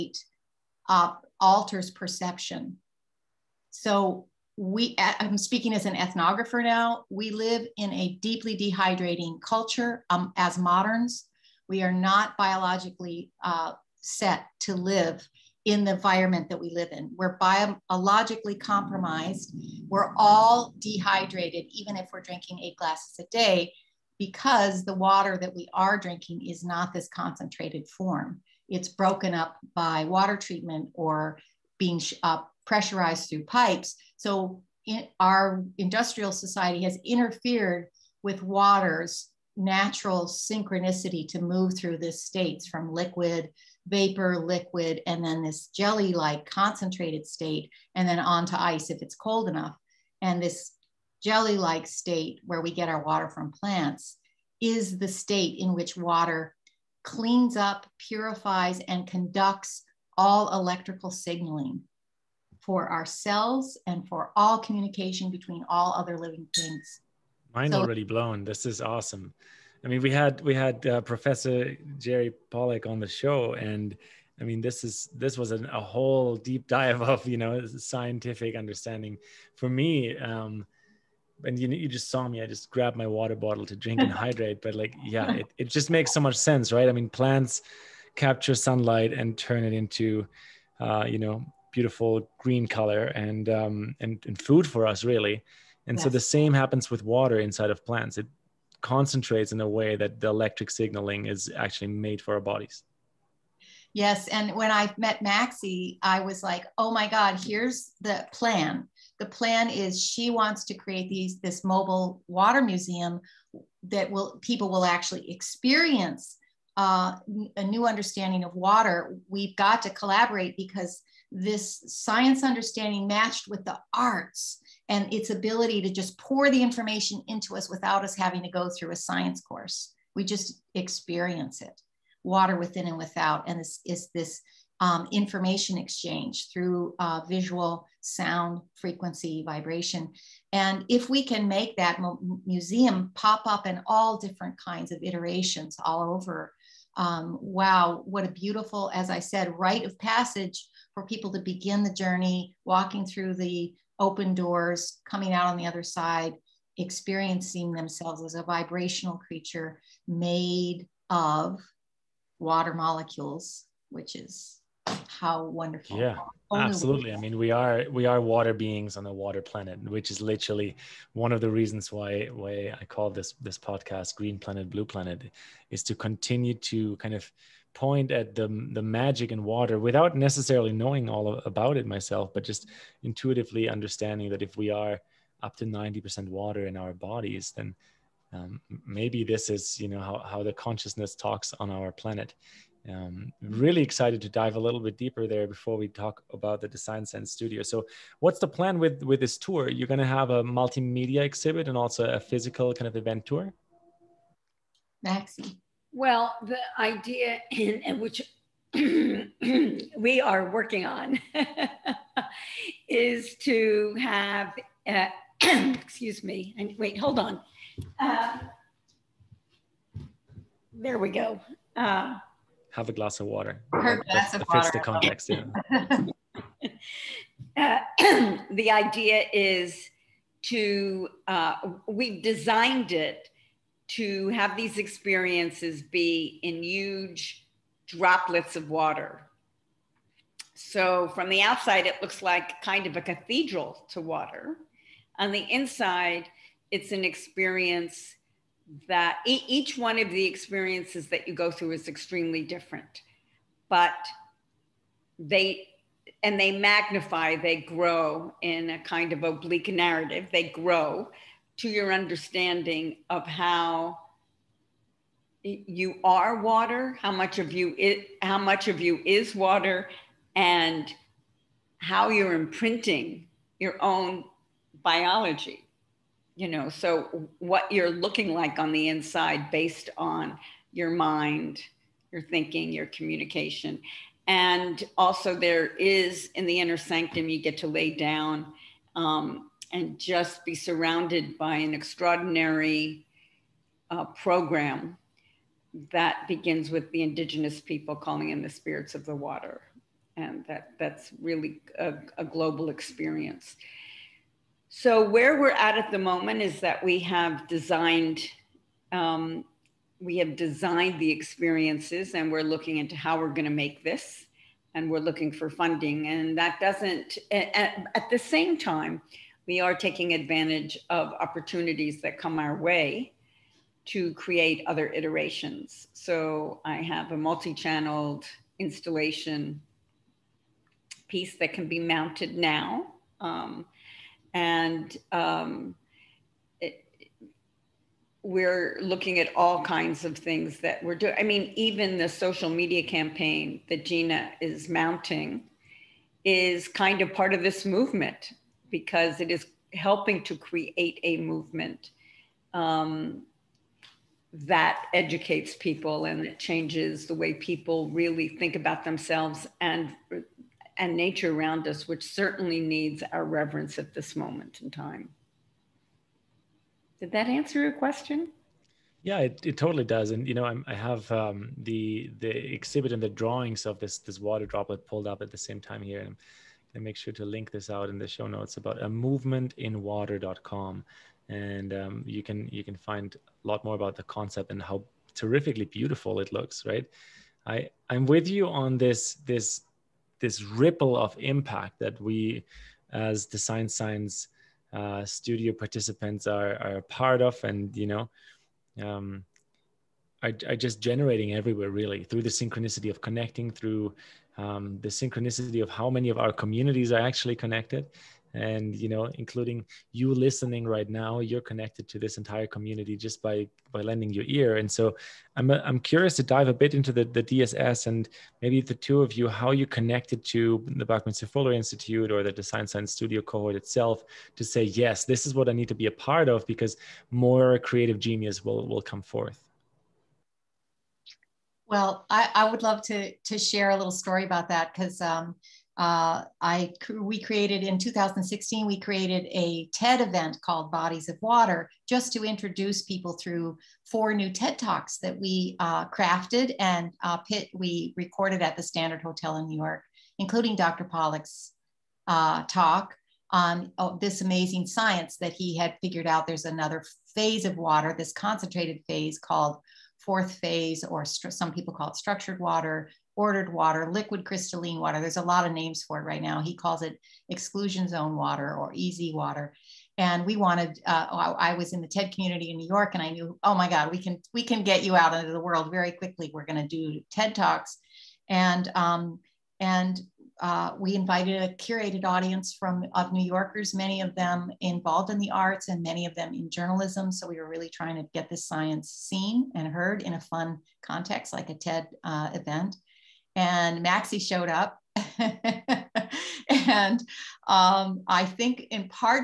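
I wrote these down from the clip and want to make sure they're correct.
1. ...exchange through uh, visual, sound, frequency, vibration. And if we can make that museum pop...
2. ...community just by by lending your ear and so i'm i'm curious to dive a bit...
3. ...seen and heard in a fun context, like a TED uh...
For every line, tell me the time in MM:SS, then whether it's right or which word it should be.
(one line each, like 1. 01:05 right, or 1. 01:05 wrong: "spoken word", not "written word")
1. 02:15 right
2. 06:52 right
3. 08:08 right.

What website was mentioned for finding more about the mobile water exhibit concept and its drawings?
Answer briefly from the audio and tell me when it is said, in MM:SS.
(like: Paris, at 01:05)
movementinwater.com, at 06:18.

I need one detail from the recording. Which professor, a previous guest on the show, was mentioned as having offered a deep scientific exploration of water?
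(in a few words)
Jerry Pollack.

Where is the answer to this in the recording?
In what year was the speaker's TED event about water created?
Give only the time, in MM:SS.
07:17.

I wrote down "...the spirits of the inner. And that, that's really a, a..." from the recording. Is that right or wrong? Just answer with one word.
wrong.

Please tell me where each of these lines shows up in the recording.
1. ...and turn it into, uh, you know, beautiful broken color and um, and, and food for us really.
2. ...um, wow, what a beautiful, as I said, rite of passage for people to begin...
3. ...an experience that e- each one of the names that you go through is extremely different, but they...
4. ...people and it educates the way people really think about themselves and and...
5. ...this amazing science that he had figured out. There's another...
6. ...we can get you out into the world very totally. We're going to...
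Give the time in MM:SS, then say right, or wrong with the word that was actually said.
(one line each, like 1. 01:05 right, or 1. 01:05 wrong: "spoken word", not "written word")
1. 01:29 wrong: "green", not "broken"
2. 02:26 right
3. 04:06 wrong: "experiences", not "names"
4. 05:55 wrong: "changes", not "educates"
5. 07:33 right
6. 07:54 wrong: "quickly", not "totally".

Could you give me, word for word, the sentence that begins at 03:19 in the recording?
You're going to have a multimedia exhibit and also a physical kind of event tour.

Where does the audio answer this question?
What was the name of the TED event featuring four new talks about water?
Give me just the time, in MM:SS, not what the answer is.
07:20.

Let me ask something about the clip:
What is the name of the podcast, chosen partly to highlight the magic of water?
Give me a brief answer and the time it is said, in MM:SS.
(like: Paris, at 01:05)
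Green Planet Blue Planet, at 02:54.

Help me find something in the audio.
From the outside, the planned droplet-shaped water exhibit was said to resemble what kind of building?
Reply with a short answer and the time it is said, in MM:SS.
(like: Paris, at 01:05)
A cathedral, at 04:03.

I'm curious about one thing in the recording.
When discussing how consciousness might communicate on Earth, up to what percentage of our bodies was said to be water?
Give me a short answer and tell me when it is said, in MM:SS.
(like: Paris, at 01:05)
90%, at 03:05.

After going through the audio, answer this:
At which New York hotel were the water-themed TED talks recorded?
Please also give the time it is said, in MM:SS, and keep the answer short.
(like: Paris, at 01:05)
The Standard Hotel, at 07:28.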